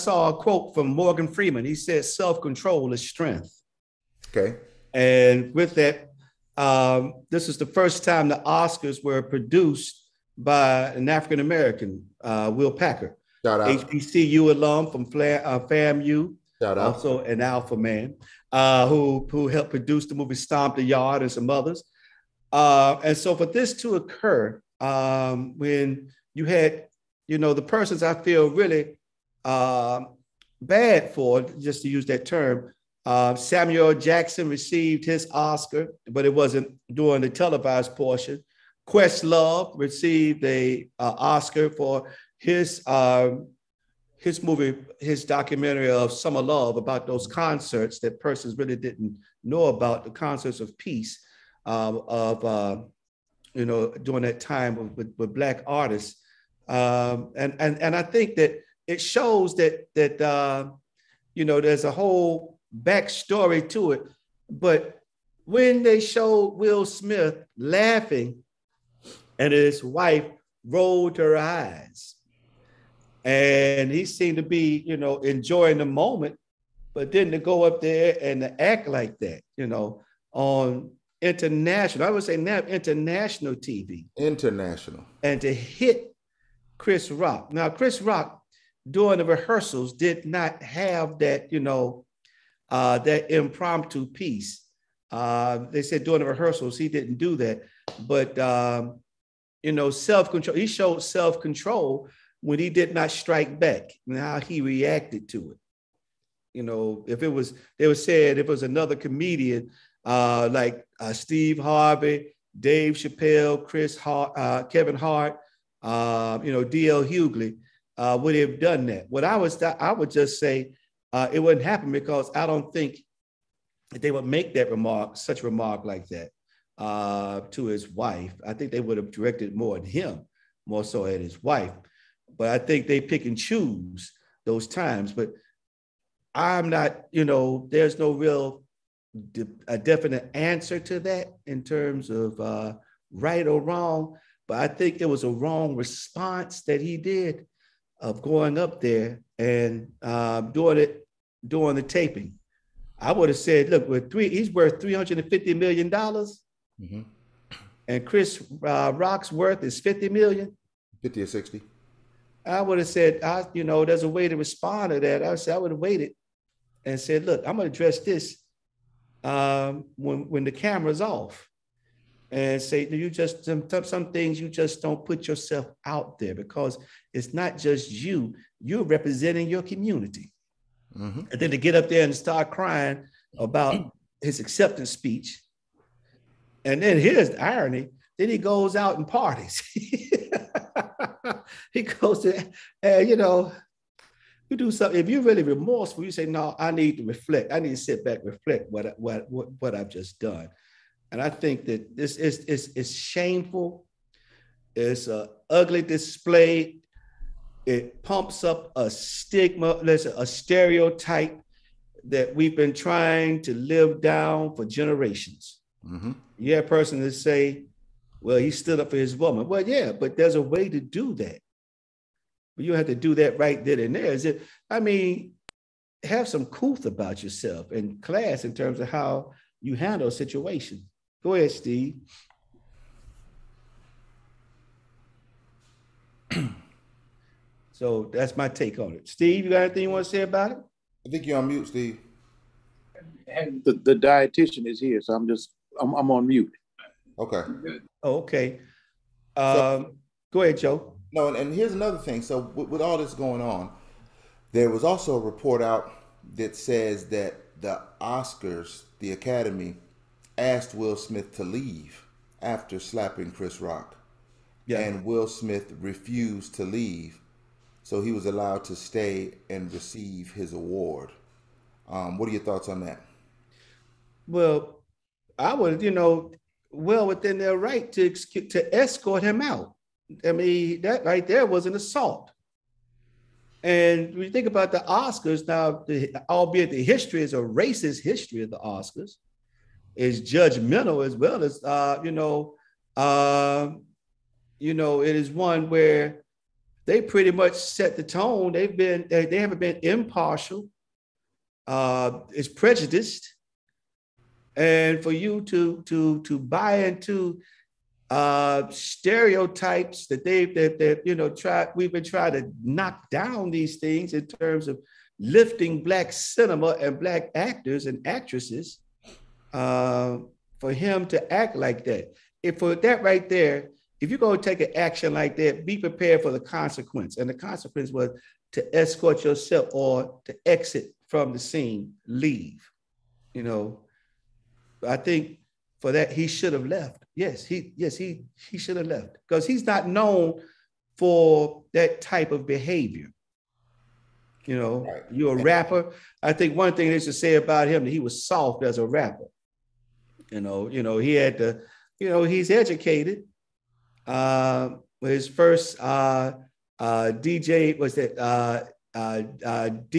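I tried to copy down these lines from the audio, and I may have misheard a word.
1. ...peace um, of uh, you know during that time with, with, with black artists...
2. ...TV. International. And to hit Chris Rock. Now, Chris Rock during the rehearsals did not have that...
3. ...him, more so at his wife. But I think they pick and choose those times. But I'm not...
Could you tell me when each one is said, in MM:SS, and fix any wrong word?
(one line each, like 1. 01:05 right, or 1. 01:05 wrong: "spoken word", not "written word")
1. 00:50 right
2. 01:23 right
3. 02:09 right.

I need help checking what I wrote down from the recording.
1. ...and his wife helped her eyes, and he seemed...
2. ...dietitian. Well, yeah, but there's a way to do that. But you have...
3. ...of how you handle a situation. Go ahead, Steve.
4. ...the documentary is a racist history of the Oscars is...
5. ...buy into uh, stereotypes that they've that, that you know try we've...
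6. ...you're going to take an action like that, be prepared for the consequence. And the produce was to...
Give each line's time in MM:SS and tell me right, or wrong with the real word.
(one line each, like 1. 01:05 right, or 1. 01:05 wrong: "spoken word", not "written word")
1. 01:09 wrong: "rolled", not "helped"
2. 03:39 wrong: "woman", not "dietitian"
3. 03:48 right
4. 04:46 wrong: "history", not "documentary"
5. 05:06 right
6. 05:24 wrong: "consequence", not "produce".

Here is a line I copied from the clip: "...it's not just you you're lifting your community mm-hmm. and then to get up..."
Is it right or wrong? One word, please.
wrong.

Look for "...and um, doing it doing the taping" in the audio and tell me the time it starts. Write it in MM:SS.
02:29.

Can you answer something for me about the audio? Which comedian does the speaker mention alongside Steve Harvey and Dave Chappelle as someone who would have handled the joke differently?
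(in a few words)
D.L. Hughley.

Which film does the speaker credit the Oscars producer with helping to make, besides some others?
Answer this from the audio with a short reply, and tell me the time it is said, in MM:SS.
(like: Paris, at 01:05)
Stomp the Yard, at 00:20.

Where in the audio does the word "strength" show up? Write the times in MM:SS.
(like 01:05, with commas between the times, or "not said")
00:03.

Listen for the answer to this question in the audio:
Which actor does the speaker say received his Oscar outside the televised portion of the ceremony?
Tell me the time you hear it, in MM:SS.
00:33.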